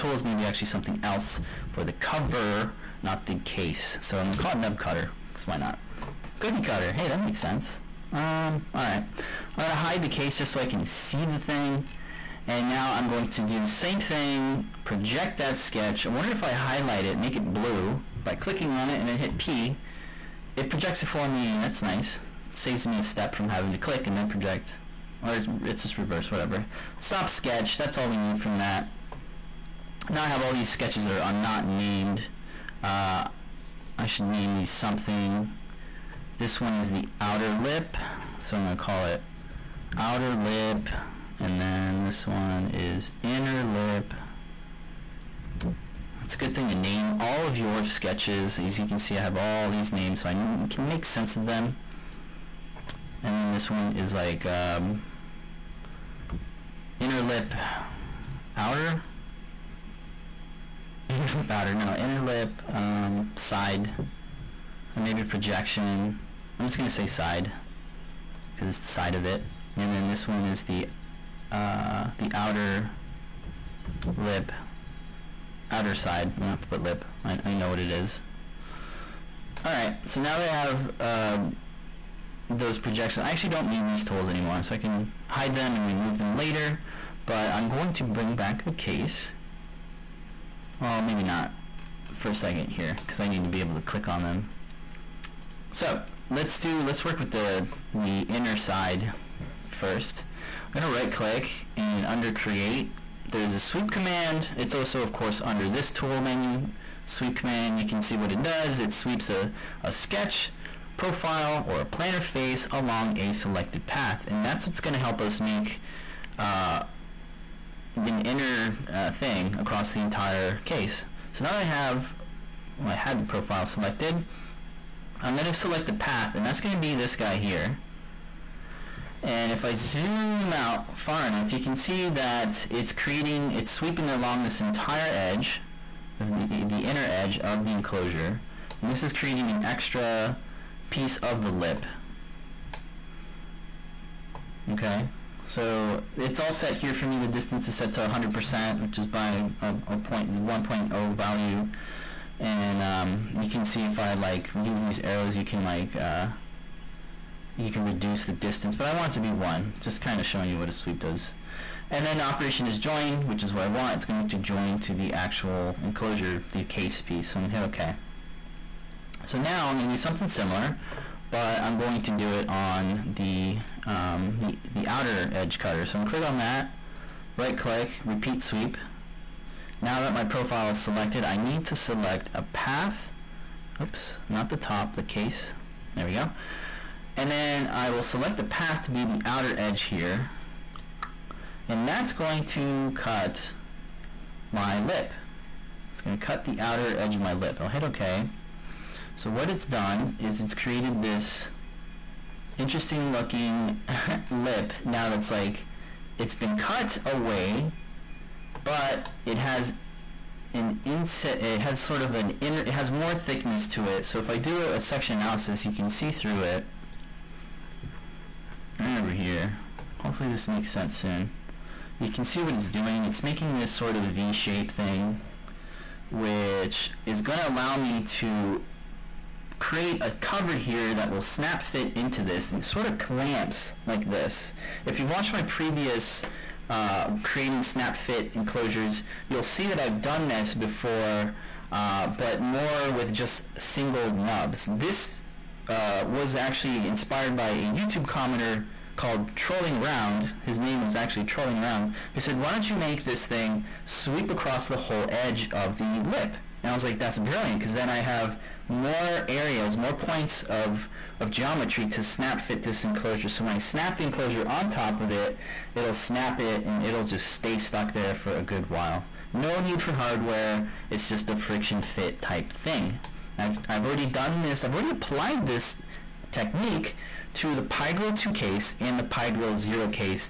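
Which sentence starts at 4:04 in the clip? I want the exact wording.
This uh, was actually inspired by a YouTube commenter called Trolling Around.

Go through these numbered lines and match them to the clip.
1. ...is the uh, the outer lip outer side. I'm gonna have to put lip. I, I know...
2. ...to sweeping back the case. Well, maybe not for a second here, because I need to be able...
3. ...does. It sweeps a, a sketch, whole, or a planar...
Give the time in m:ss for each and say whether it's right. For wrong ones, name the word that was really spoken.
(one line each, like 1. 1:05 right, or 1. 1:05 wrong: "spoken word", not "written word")
1. 1:10 right
2. 1:27 wrong: "bring", not "sweeping"
3. 1:48 wrong: "profile", not "whole".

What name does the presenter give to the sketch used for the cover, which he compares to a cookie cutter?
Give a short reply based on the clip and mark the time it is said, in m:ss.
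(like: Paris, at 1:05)
nub cutter, at 0:04.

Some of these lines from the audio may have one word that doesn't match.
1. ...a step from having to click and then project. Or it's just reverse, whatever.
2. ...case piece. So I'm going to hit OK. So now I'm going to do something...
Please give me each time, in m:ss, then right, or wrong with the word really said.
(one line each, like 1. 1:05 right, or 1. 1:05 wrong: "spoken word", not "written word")
1. 0:22 right
2. 2:46 right.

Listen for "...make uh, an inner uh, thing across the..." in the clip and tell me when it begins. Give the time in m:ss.
1:55.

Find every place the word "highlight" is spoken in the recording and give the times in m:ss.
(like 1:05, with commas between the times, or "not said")
0:16.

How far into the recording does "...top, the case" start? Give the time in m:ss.
3:04.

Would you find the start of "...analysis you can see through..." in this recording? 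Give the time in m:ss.
3:35.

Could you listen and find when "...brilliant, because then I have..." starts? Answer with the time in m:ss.
4:17.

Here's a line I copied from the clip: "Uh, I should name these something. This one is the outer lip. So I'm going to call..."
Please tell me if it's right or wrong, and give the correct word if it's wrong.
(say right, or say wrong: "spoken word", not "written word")
right.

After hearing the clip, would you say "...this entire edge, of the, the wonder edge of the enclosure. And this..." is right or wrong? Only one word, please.
wrong.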